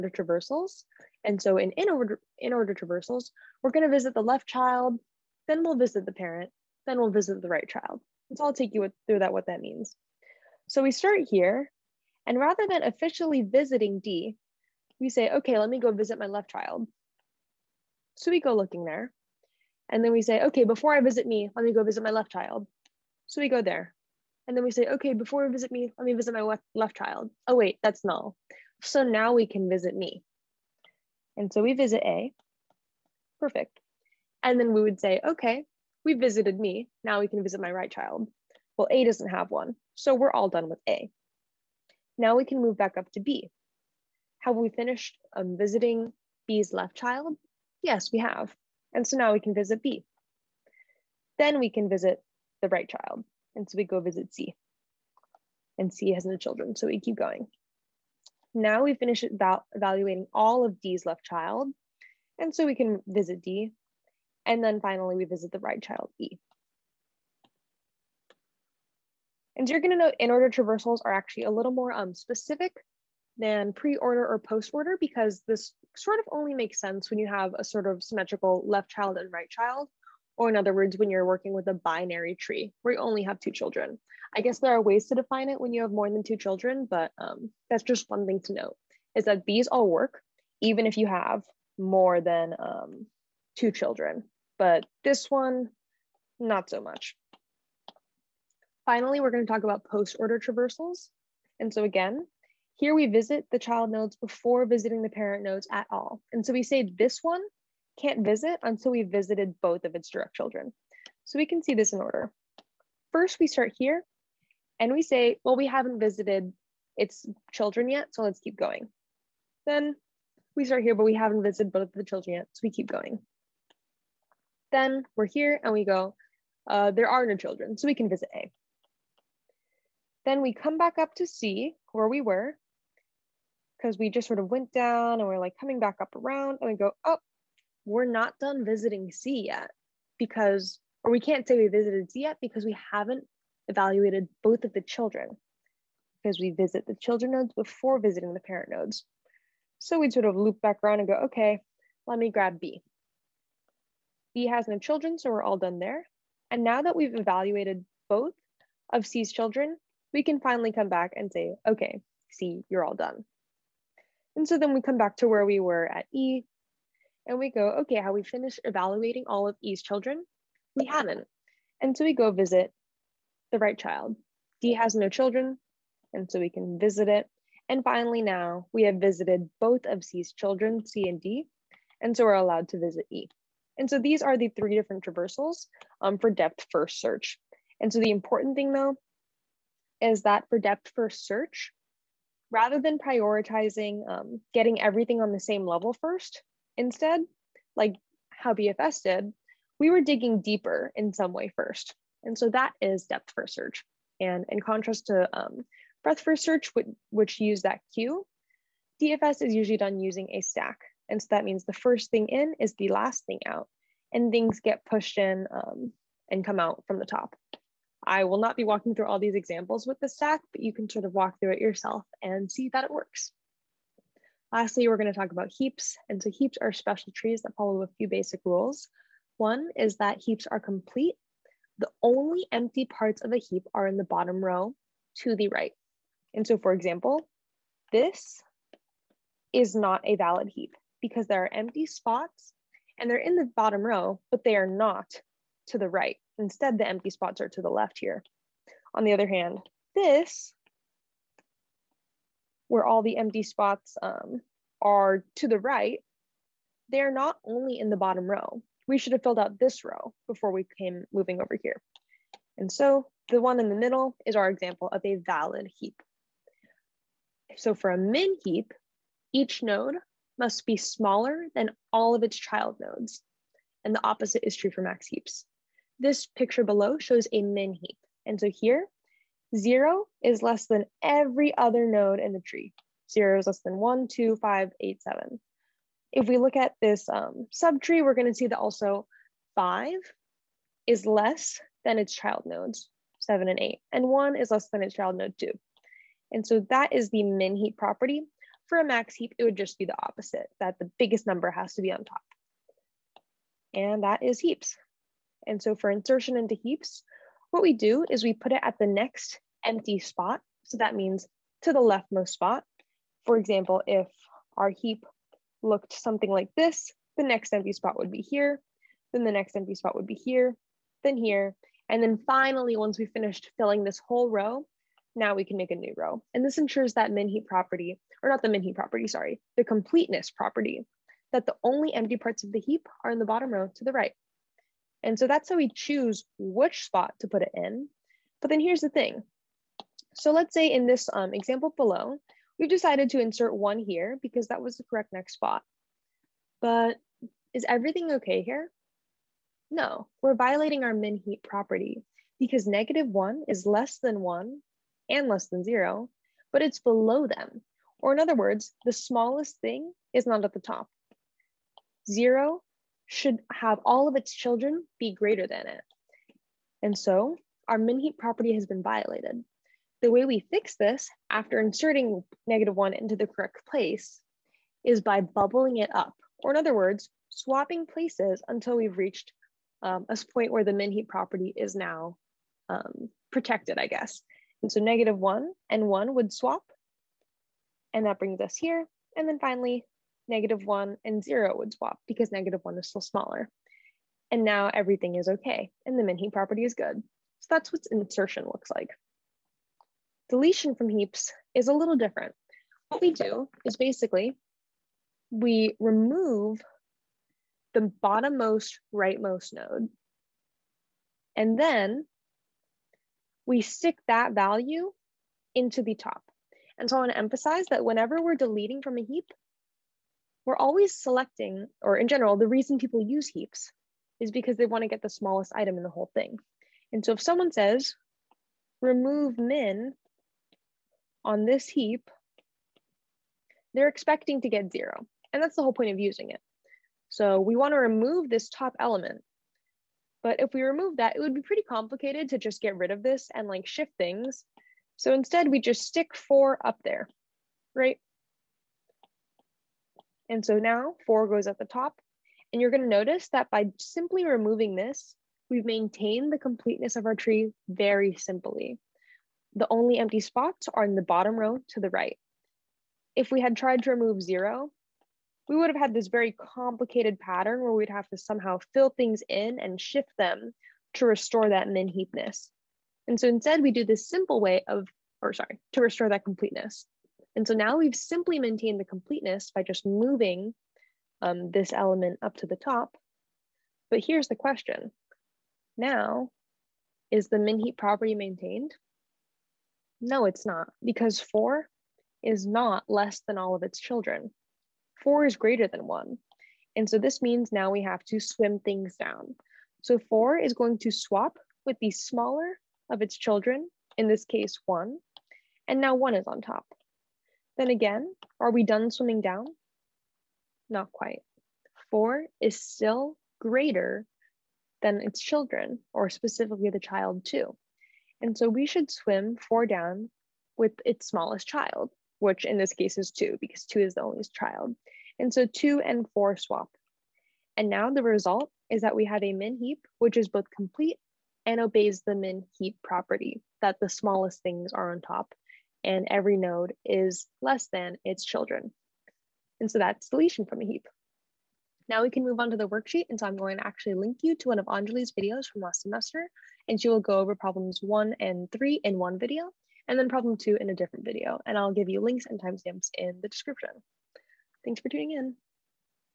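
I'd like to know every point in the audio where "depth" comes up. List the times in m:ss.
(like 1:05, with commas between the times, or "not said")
3:06, 3:10, 3:23.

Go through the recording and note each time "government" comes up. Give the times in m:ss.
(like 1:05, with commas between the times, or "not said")
not said.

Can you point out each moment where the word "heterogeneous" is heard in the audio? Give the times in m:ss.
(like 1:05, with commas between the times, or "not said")
not said.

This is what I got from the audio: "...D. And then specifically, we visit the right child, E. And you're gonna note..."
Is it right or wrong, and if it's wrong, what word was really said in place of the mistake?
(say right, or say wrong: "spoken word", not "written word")
wrong: "finally", not "specifically".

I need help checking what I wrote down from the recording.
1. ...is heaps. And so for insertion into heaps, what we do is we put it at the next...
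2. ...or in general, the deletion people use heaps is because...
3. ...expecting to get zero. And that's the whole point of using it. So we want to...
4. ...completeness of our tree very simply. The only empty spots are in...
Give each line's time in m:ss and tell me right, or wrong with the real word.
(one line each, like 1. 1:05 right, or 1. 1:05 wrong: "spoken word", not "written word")
1. 5:04 right
2. 7:01 wrong: "reason", not "deletion"
3. 7:13 right
4. 7:36 right.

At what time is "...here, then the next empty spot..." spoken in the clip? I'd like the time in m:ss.
5:18.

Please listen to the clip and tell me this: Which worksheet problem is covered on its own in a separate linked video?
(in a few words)
Problem 2.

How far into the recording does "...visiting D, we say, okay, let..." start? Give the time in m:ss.
0:13.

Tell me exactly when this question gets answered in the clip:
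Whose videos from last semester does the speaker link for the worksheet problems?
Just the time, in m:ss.
9:04.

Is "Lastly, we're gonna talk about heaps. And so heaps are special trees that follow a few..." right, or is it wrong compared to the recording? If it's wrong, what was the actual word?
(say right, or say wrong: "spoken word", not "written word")
right.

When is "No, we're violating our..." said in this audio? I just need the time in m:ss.
5:49.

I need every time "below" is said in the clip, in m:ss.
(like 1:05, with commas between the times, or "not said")
4:36, 5:41, 5:56.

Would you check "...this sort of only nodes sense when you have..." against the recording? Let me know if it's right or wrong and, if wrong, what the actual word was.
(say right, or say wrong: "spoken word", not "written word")
wrong: "makes", not "nodes".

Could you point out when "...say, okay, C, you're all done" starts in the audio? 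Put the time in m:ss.
2:41.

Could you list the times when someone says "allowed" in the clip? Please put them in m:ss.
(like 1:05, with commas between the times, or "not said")
3:02.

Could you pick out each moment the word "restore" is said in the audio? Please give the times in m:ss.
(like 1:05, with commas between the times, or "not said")
7:51, 7:55.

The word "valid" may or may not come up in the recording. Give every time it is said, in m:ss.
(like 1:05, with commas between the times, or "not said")
4:00, 4:25.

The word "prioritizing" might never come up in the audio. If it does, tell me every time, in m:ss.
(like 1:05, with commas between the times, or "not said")
3:12.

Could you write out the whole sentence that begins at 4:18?
We should have filled out this row before we came moving over here.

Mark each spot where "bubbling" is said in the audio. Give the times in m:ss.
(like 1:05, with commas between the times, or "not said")
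6:15.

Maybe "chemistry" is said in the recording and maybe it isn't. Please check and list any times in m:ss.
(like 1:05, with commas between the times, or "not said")
not said.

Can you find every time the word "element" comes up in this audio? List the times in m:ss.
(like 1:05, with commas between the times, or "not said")
7:18, 8:01.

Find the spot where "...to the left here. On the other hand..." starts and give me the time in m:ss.
4:07.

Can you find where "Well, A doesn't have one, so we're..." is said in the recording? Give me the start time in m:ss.
0:38.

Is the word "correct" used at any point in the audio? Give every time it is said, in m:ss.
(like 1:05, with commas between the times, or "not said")
5:44, 6:13.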